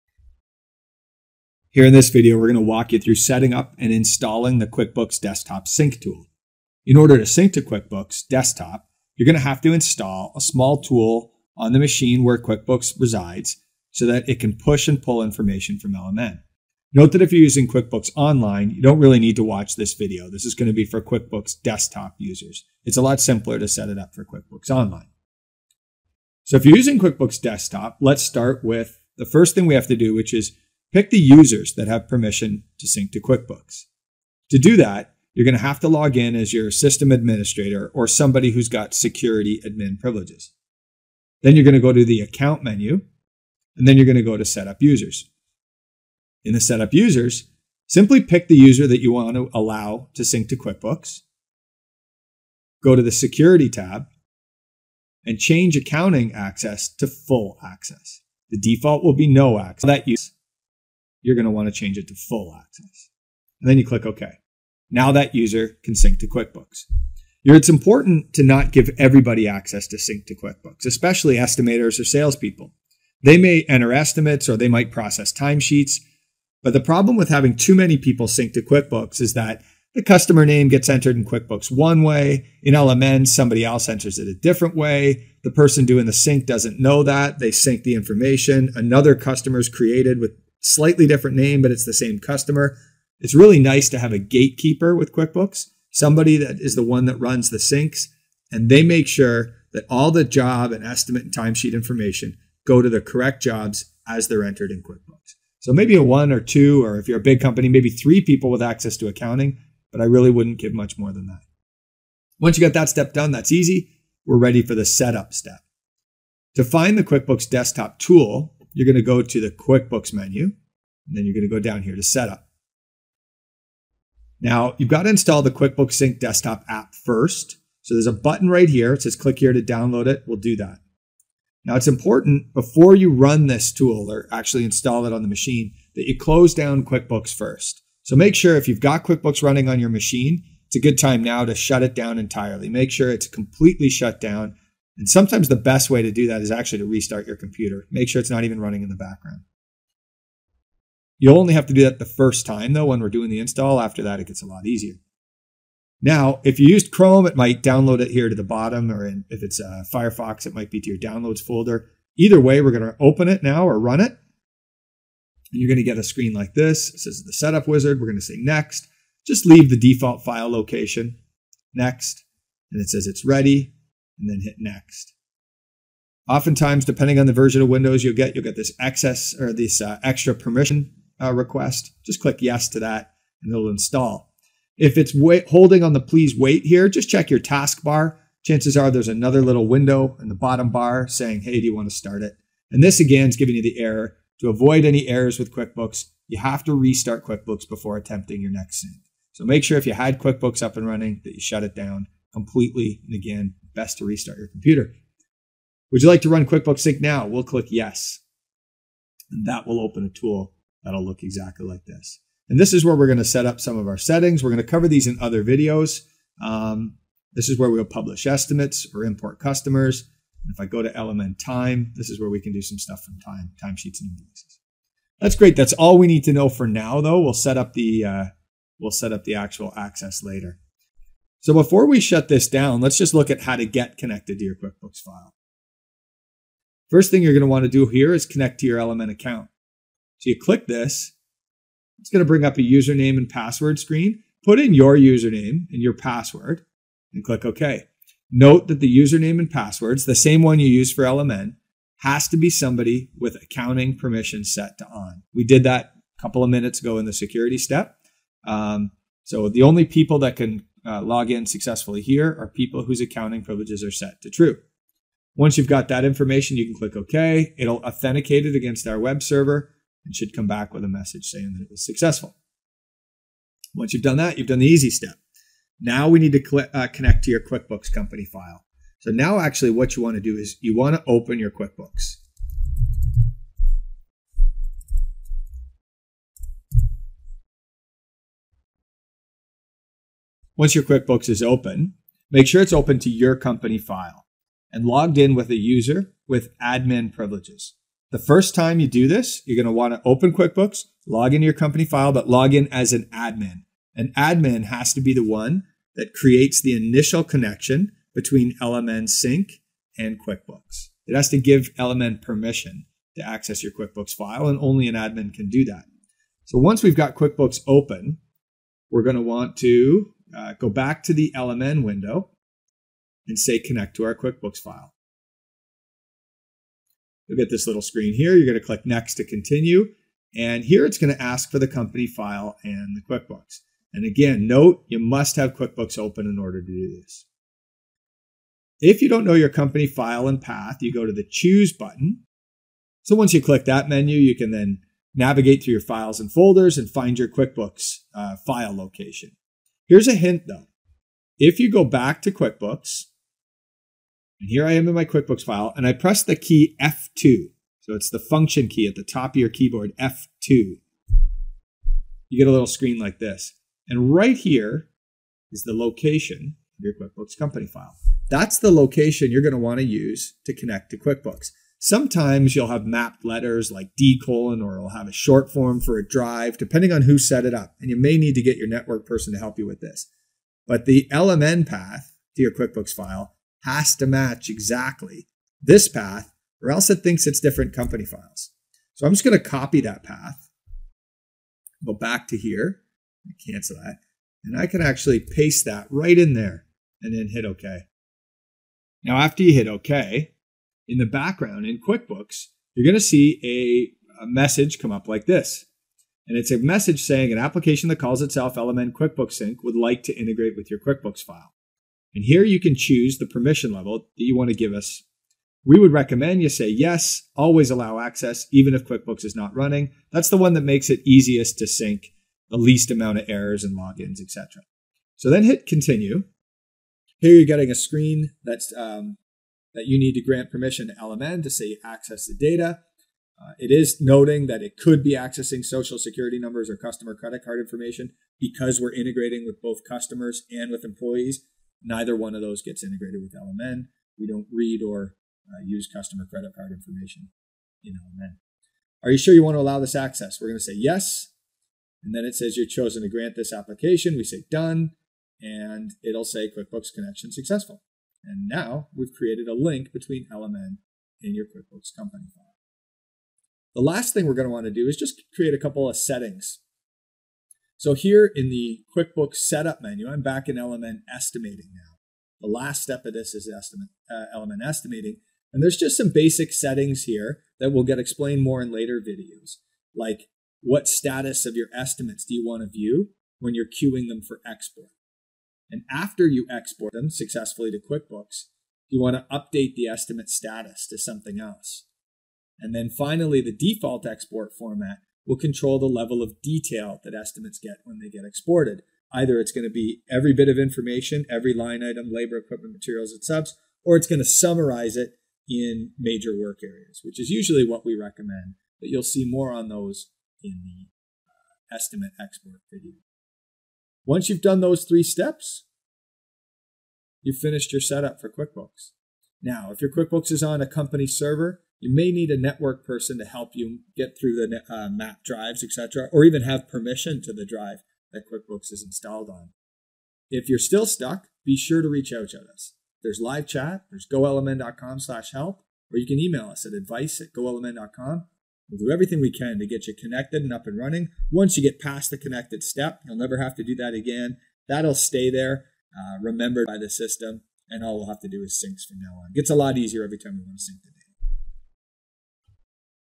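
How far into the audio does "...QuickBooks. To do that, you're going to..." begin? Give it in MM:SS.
00:33.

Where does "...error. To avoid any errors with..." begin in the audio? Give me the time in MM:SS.
03:13.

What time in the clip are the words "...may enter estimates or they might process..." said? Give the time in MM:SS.
01:13.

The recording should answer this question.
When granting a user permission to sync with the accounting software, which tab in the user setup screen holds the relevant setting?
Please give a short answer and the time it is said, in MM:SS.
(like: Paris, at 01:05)
Security tab, at 00:53.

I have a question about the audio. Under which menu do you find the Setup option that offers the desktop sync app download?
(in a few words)
QuickBooks menu.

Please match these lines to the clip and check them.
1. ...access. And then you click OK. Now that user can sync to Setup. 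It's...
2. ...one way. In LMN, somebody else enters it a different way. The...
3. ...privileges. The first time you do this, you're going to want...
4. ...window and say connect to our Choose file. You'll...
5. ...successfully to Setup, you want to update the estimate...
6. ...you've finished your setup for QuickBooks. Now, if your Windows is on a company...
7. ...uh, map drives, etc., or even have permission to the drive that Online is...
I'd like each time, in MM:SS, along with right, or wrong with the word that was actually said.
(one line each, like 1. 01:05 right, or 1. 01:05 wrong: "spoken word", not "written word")
1. 01:02 wrong: "QuickBooks", not "Setup"
2. 01:21 right
3. 04:57 right
4. 05:21 wrong: "QuickBooks", not "Choose"
5. 08:07 wrong: "QuickBooks", not "Setup"
6. 08:37 wrong: "QuickBooks", not "Windows"
7. 08:44 wrong: "QuickBooks", not "Online".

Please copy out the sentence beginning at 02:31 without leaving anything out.
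You'll only have to do that the first time, though, when we're doing the install.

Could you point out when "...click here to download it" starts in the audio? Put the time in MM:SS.
02:09.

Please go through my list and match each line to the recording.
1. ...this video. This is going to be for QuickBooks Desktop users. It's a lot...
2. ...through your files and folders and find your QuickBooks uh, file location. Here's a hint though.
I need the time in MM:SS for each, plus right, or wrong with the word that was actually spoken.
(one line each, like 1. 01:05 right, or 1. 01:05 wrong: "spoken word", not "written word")
1. 00:19 right
2. 05:45 right.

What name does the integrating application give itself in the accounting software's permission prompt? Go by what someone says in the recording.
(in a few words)
LMN QuickBooks Sync.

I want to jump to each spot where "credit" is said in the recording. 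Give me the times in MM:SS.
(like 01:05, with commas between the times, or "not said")
07:17, 07:26.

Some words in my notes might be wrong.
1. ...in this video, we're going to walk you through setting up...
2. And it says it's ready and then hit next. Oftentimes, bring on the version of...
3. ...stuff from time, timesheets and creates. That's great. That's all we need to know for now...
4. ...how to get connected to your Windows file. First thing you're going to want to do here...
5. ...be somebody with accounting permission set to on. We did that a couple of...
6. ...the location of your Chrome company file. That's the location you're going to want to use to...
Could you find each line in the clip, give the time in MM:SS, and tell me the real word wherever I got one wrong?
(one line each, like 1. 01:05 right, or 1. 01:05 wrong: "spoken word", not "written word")
1. 00:01 right
2. 02:52 wrong: "depending", not "bring"
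3. 03:42 wrong: "invoices", not "creates"
4. 03:53 wrong: "QuickBooks", not "Windows"
5. 04:12 right
6. 06:05 wrong: "QuickBooks", not "Chrome".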